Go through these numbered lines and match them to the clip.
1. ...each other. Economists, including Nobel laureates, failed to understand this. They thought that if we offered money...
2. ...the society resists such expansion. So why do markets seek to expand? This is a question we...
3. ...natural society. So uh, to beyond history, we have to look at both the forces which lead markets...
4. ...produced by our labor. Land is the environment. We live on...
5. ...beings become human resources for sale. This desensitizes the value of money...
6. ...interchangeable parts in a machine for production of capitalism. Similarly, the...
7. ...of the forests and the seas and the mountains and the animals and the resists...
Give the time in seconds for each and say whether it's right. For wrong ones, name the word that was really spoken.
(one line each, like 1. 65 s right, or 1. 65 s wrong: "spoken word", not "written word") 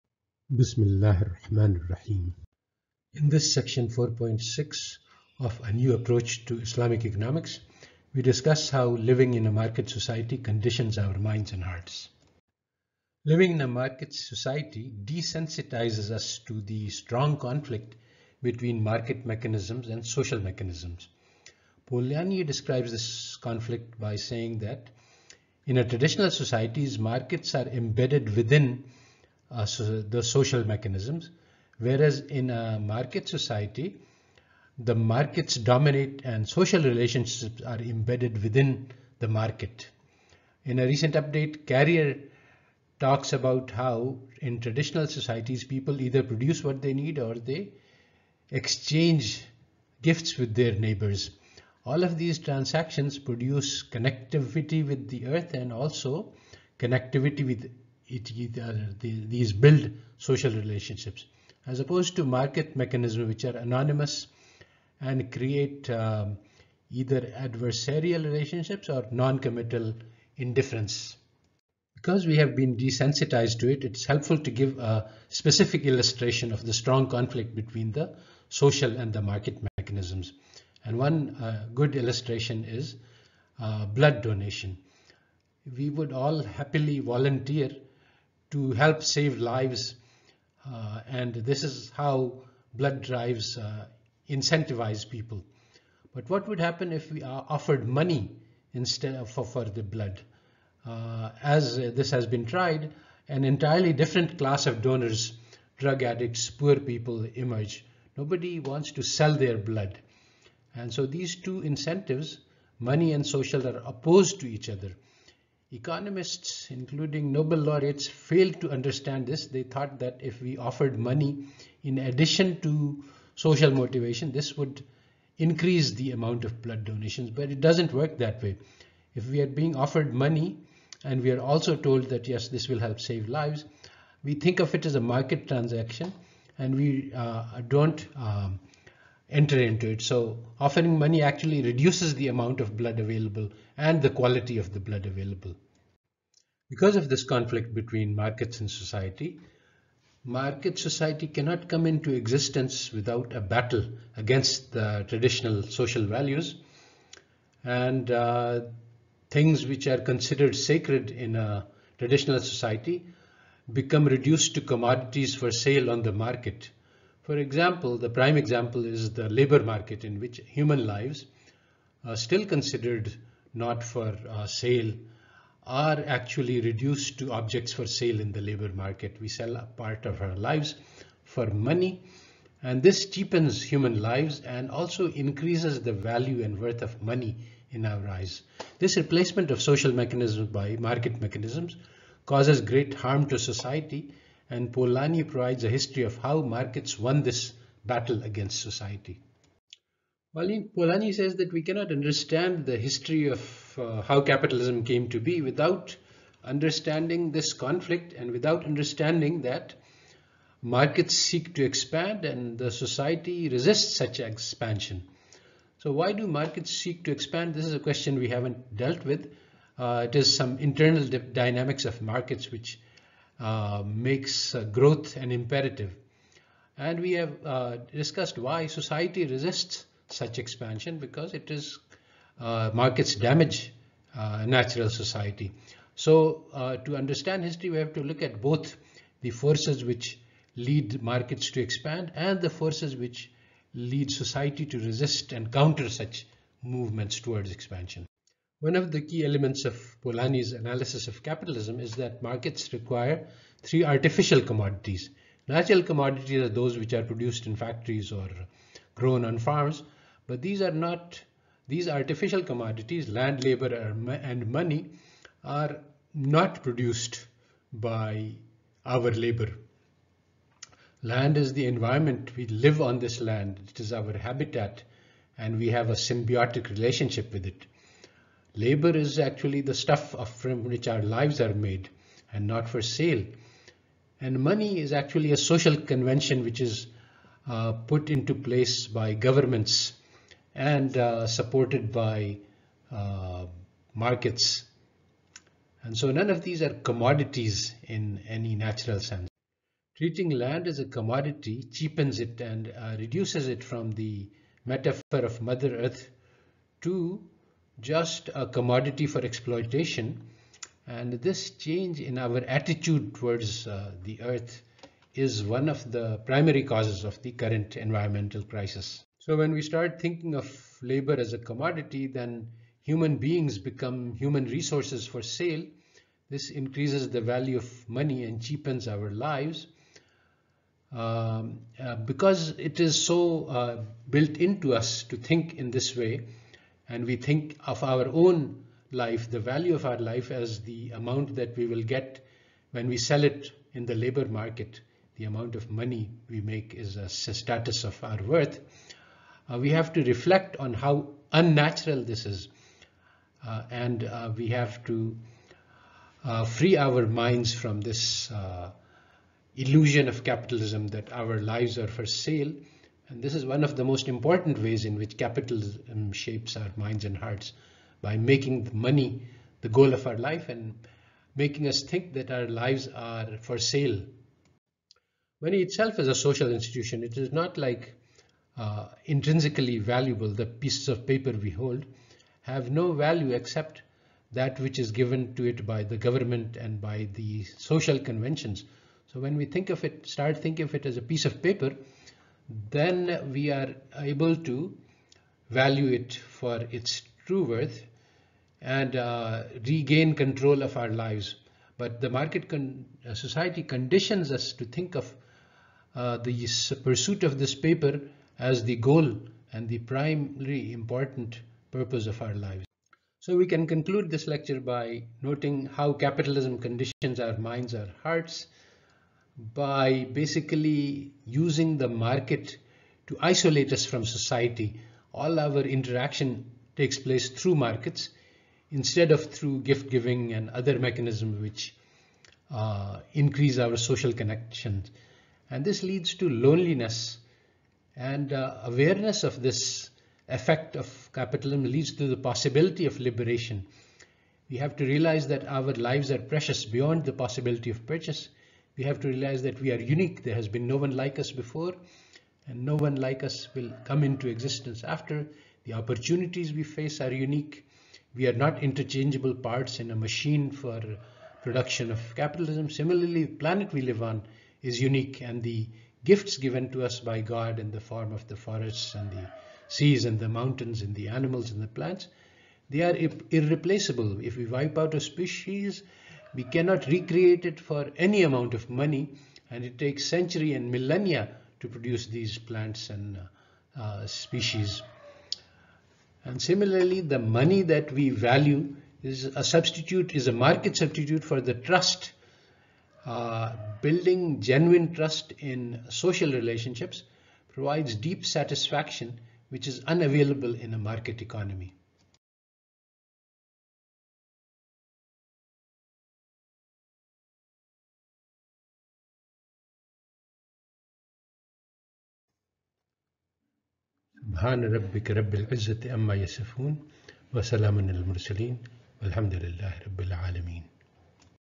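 1. 114 s right
2. 212 s right
3. 234 s wrong: "understand", not "beyond"
4. 266 s right
5. 323 s wrong: "increases", not "desensitizes"
6. 458 s right
7. 468 s wrong: "plants", not "resists".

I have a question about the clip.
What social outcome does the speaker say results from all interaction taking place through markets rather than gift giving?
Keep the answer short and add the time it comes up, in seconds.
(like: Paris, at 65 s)
Loneliness, at 436 s.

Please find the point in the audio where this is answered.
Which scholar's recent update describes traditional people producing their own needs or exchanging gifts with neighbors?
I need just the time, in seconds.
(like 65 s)
41 s.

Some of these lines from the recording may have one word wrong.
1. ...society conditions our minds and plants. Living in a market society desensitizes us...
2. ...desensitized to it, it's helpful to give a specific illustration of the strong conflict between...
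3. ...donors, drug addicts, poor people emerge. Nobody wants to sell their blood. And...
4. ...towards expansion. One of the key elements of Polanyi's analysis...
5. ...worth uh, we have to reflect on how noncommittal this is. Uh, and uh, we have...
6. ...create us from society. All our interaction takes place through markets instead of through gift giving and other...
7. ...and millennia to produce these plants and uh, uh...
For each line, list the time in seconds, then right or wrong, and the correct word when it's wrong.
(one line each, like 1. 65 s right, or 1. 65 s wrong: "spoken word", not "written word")
1. 9 s wrong: "hearts", not "plants"
2. 72 s right
3. 104 s right
4. 247 s right
5. 348 s wrong: "unnatural", not "noncommittal"
6. 423 s wrong: "isolate", not "create"
7. 480 s right.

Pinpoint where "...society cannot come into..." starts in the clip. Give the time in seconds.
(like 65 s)
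150 s.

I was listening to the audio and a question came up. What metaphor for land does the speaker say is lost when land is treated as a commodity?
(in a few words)
Mother Earth.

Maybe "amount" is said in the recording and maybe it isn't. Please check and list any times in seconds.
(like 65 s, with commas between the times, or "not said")
126 s, 142 s, 340 s, 345 s, 478 s.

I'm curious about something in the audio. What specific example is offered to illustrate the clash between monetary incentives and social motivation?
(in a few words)
Blood donation.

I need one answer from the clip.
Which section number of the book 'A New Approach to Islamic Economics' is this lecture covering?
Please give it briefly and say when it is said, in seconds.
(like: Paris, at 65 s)
4.6, at 3 s.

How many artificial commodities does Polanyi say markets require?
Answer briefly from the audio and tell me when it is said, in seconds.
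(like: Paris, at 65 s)
3, at 253 s.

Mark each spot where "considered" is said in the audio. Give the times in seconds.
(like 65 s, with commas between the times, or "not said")
159 s, 172 s.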